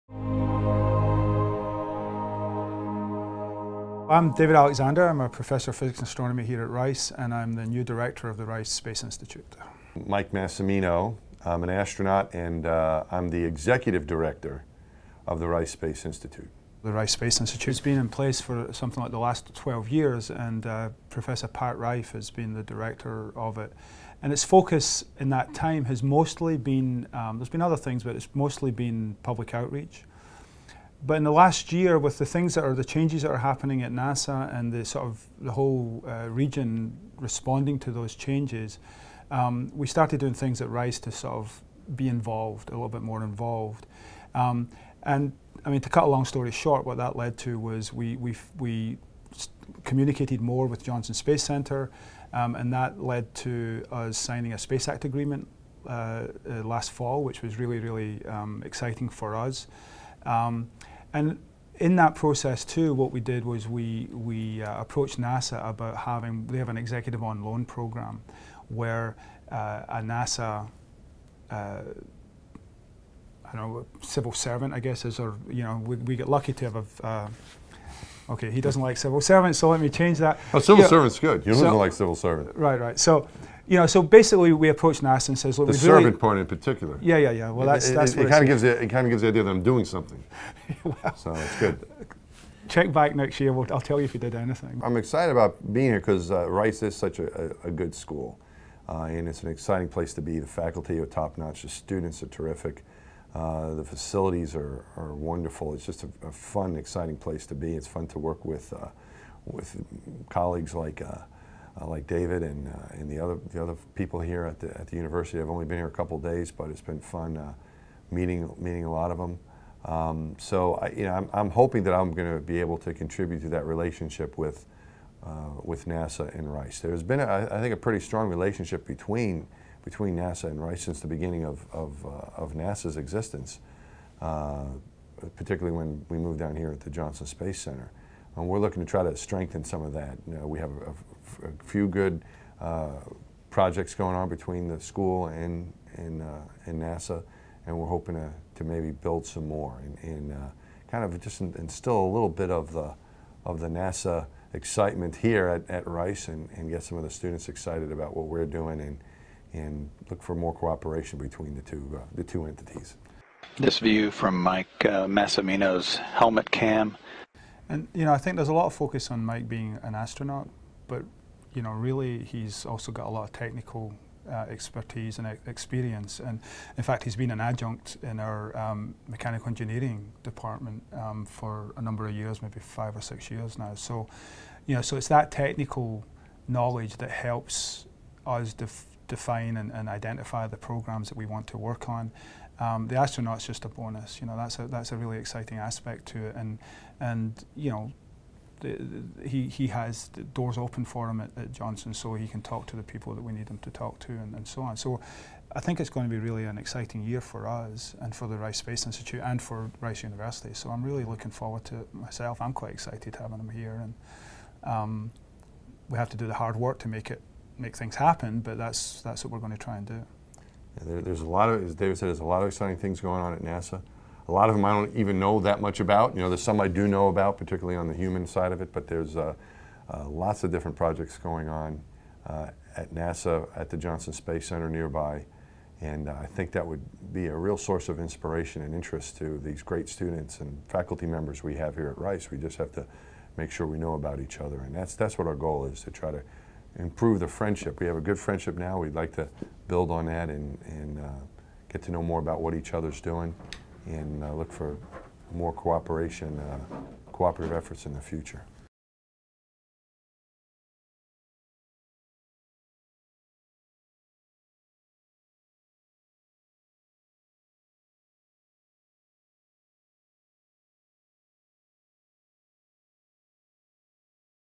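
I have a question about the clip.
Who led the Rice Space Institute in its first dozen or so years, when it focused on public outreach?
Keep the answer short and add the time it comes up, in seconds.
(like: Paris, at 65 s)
Pat Reiff, at 21 s.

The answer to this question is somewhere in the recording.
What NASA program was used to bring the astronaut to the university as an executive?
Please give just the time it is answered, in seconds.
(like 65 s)
66 s.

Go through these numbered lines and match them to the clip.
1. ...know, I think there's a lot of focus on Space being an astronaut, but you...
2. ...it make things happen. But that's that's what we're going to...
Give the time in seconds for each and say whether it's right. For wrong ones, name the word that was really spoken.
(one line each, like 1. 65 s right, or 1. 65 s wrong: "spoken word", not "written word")
1. 168 s wrong: "Mike", not "Space"
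2. 217 s right.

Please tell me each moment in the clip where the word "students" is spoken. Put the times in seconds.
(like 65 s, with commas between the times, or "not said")
101 s, 157 s, 239 s.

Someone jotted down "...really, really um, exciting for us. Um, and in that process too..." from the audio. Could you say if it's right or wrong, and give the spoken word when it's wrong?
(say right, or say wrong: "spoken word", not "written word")
right.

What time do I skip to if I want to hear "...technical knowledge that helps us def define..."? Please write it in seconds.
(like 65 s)
185 s.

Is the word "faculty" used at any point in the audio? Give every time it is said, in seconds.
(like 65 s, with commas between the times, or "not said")
100 s, 240 s.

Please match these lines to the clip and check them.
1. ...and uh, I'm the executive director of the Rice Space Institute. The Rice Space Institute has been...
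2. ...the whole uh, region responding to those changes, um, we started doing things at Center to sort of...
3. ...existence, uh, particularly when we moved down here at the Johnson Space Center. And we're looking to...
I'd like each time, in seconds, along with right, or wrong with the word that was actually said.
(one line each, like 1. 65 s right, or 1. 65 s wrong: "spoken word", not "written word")
1. 12 s right
2. 35 s wrong: "Rice", not "Center"
3. 132 s right.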